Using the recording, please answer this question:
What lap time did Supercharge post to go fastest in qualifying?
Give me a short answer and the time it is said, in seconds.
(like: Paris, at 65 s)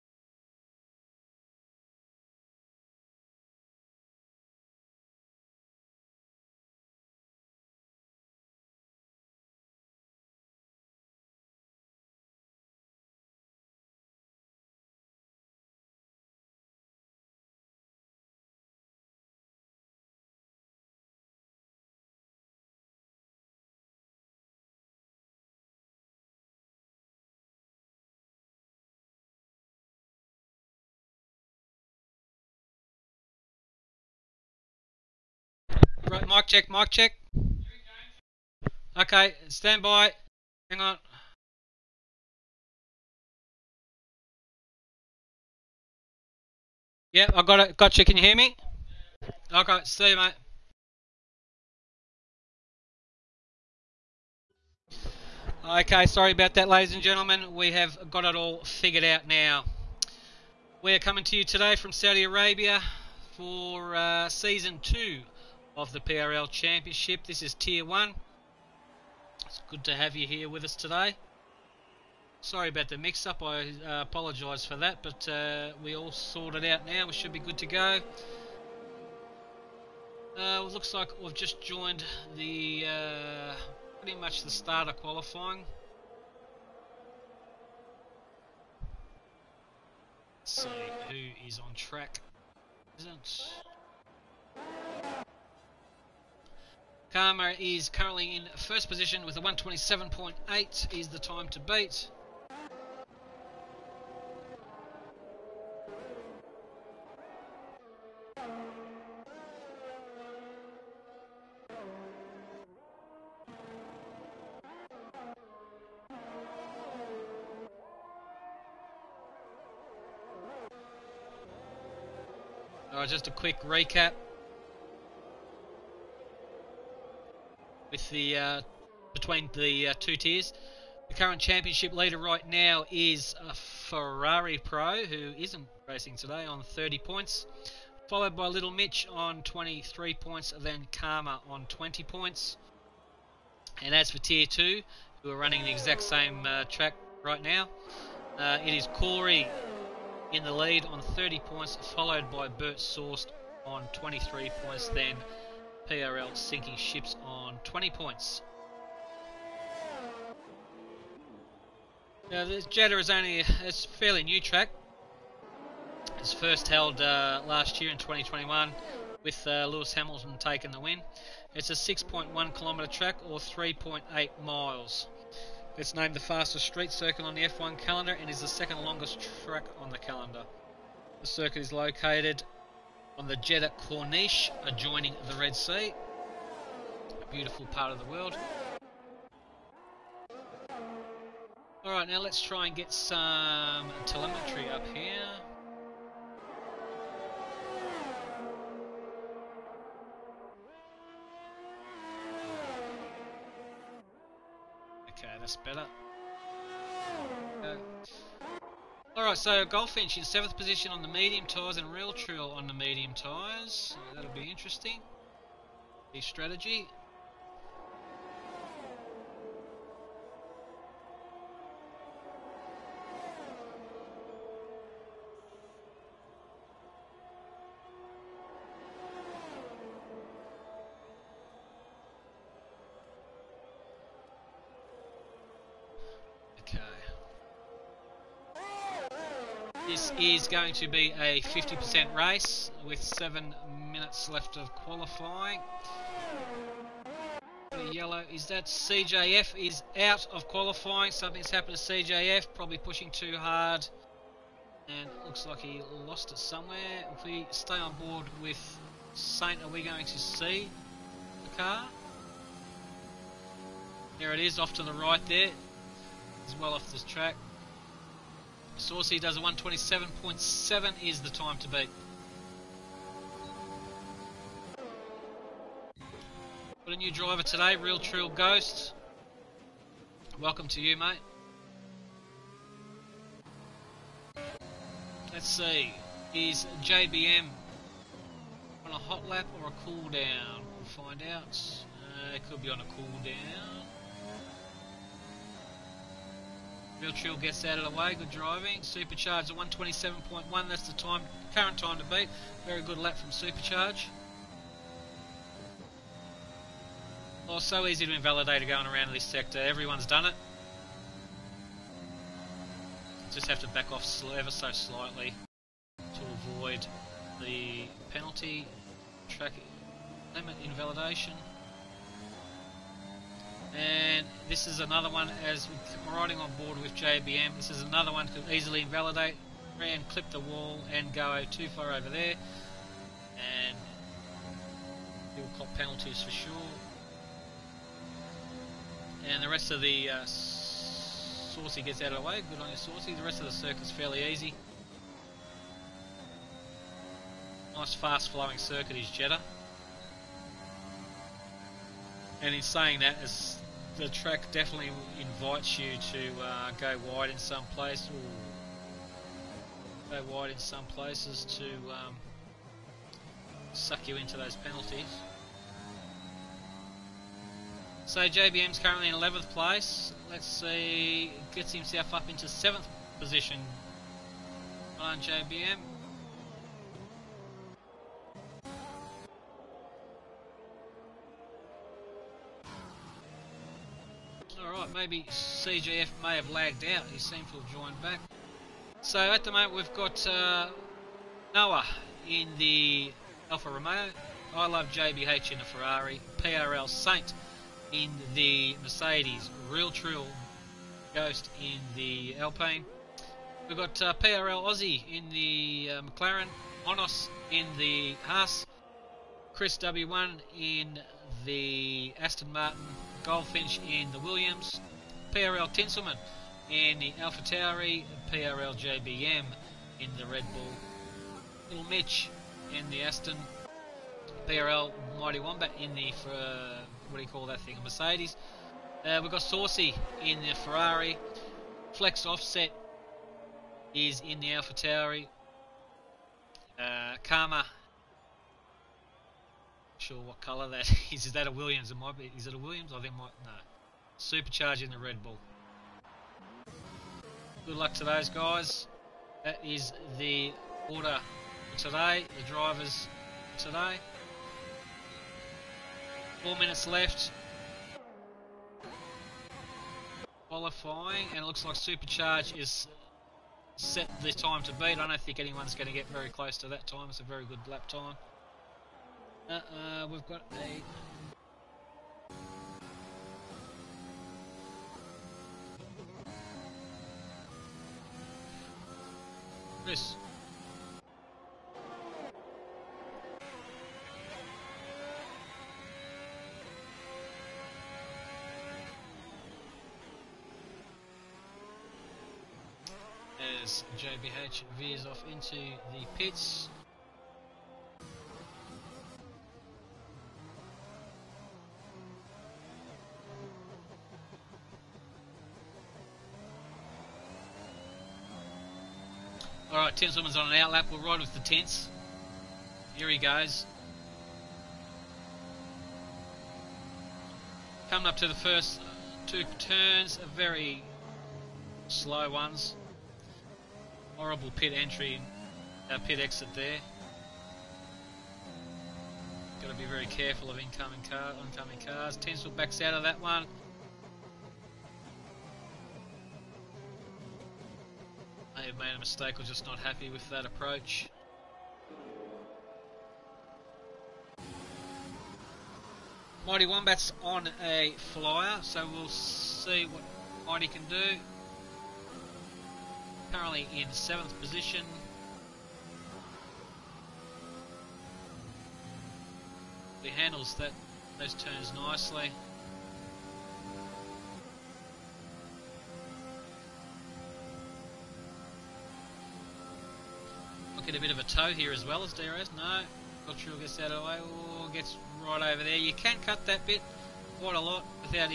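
127.1, at 299 s.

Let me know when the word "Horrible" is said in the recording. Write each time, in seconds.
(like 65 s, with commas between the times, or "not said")
524 s.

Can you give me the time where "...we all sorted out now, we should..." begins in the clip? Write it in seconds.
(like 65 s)
75 s.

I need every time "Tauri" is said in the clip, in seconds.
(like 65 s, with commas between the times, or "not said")
417 s, 434 s.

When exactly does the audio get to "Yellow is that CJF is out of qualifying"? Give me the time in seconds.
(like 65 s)
247 s.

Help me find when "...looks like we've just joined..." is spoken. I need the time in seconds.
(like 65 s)
80 s.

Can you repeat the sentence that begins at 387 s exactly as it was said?
He seems to have joined back.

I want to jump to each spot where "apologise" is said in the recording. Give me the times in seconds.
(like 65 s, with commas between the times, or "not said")
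74 s.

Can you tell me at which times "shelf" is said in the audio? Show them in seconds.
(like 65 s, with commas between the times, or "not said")
not said.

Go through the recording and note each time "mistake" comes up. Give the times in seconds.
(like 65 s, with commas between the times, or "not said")
538 s.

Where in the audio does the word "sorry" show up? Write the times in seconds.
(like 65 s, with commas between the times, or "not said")
56 s, 72 s.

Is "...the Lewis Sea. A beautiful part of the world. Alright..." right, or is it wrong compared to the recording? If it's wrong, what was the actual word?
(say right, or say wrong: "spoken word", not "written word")
wrong: "Red", not "Lewis".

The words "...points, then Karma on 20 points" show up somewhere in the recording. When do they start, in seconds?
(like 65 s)
140 s.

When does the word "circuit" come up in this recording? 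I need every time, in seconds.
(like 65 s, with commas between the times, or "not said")
176 s, 181 s, 343 s, 348 s.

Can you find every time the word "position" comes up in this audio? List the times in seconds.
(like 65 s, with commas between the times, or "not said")
98 s, 210 s, 373 s, 554 s.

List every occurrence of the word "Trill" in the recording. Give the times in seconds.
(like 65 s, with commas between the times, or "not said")
212 s, 277 s, 297 s, 399 s.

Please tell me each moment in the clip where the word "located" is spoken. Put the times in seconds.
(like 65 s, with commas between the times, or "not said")
181 s.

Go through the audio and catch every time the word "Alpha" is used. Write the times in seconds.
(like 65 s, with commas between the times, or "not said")
417 s, 434 s.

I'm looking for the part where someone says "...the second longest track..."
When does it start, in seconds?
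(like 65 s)
178 s.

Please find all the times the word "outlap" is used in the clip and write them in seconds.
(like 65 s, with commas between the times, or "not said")
510 s.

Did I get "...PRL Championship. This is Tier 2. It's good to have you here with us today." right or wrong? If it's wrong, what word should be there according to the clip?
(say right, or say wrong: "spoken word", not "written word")
wrong: "1", not "2".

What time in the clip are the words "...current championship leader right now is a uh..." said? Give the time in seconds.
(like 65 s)
131 s.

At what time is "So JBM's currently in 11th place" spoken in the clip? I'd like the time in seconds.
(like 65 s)
368 s.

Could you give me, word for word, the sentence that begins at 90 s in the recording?
Let's see who is on track.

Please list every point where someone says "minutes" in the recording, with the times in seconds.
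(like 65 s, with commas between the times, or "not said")
243 s, 456 s.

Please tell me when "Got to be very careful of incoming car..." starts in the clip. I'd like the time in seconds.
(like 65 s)
529 s.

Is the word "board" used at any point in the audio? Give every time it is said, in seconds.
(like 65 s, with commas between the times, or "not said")
257 s, 326 s.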